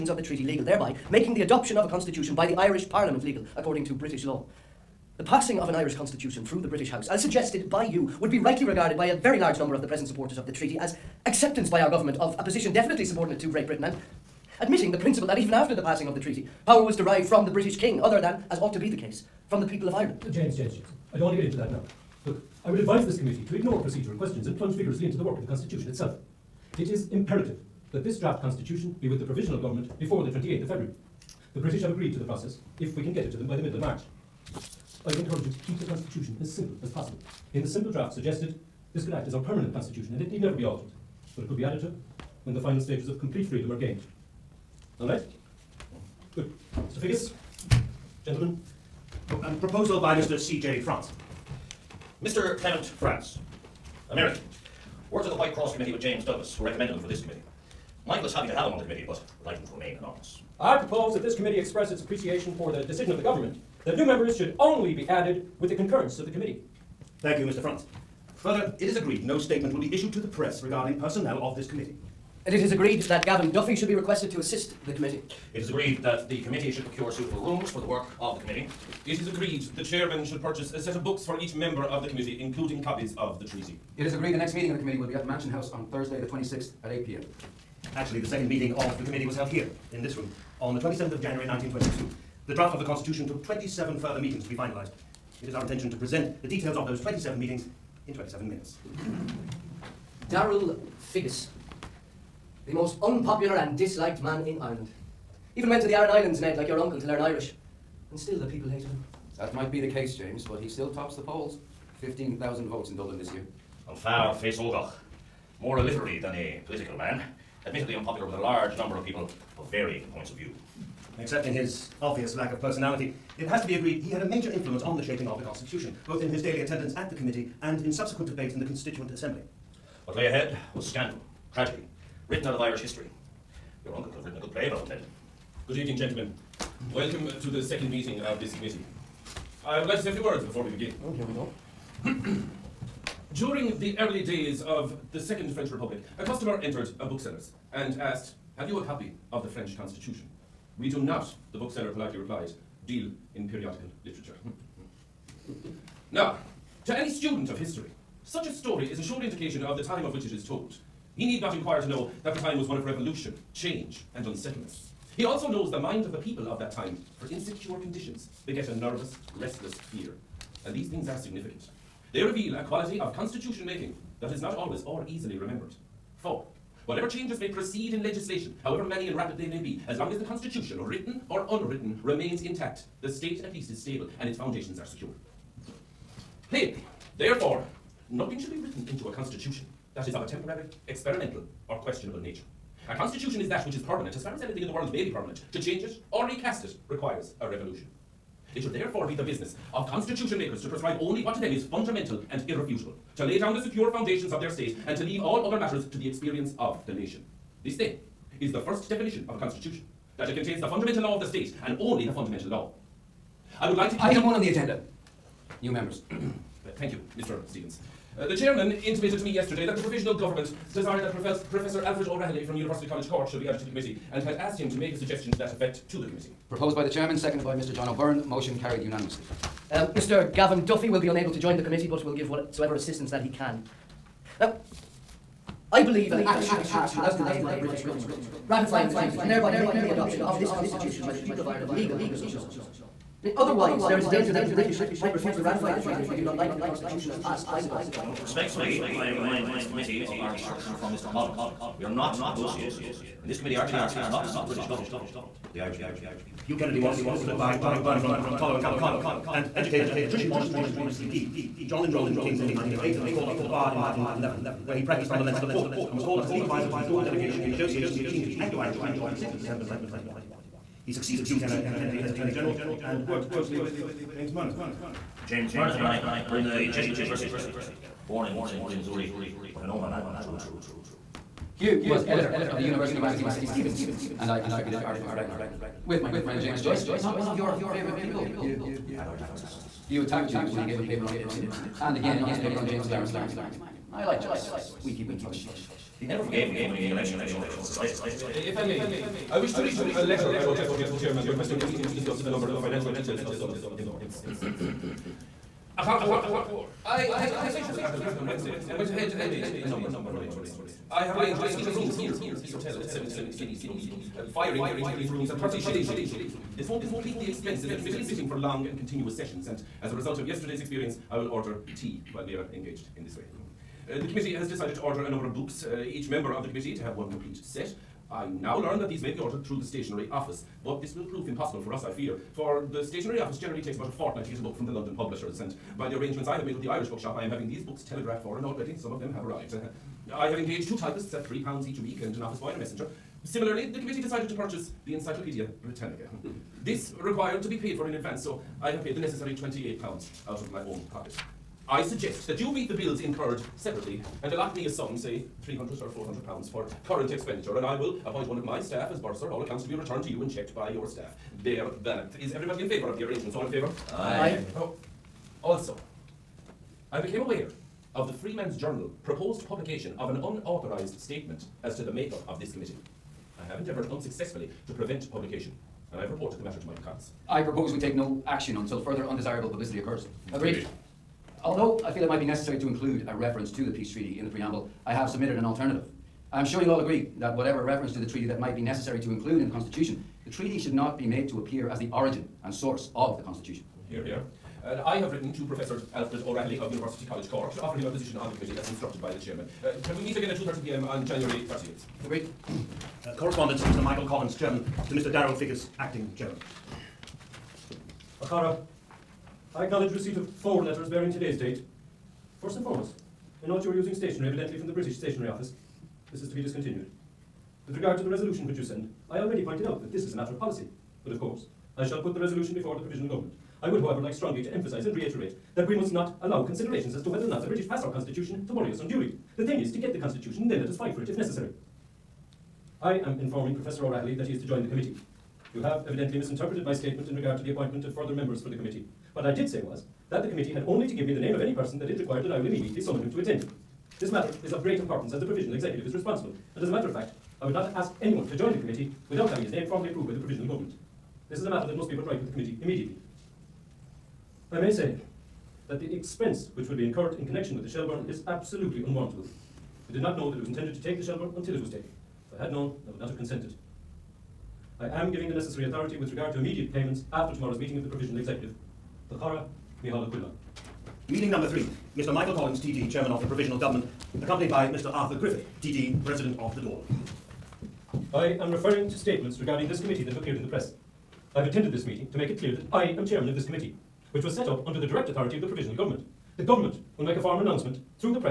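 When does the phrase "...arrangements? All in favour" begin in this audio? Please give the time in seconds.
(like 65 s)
363 s.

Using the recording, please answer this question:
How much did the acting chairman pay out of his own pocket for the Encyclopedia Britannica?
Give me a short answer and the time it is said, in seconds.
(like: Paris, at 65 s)
£28, at 349 s.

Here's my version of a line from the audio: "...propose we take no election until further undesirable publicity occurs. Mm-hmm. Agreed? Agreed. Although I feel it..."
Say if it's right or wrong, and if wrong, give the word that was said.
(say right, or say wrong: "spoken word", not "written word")
wrong: "action", not "election".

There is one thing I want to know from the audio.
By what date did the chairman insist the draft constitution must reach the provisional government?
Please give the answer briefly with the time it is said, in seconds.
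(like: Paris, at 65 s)
28th of February, at 30 s.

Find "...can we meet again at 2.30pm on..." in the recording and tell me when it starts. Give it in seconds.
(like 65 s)
399 s.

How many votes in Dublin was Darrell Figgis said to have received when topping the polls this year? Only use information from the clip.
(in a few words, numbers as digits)
15,000.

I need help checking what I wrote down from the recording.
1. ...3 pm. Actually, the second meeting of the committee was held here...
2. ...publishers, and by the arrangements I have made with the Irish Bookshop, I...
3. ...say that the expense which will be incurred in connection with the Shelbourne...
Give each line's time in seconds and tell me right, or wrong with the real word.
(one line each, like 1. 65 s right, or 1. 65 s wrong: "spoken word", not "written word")
1. 86 s wrong: "8", not "3"
2. 334 s right
3. 454 s right.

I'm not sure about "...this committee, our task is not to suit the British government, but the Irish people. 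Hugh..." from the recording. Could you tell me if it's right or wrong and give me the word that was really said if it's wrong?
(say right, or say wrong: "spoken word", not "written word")
right.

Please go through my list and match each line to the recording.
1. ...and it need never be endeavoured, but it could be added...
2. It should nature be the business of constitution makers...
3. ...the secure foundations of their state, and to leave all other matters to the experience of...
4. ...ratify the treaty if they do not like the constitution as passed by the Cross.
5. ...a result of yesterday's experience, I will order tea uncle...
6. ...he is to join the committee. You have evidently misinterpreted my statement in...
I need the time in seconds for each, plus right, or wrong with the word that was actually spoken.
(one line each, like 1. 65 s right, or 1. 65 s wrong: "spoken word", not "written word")
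1. 40 s wrong: "altered", not "endeavoured"
2. 198 s wrong: "therefore", not "nature"
3. 203 s right
4. 245 s wrong: "Dáil", not "Cross"
5. 319 s wrong: "while", not "uncle"
6. 434 s right.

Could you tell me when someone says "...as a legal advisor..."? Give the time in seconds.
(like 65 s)
266 s.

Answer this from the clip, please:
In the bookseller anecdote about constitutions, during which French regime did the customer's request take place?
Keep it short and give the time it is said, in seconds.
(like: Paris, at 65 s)
Second French Republic, at 145 s.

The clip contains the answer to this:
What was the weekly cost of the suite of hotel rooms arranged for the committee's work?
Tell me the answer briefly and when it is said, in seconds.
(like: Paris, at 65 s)
17 guineas, at 312 s.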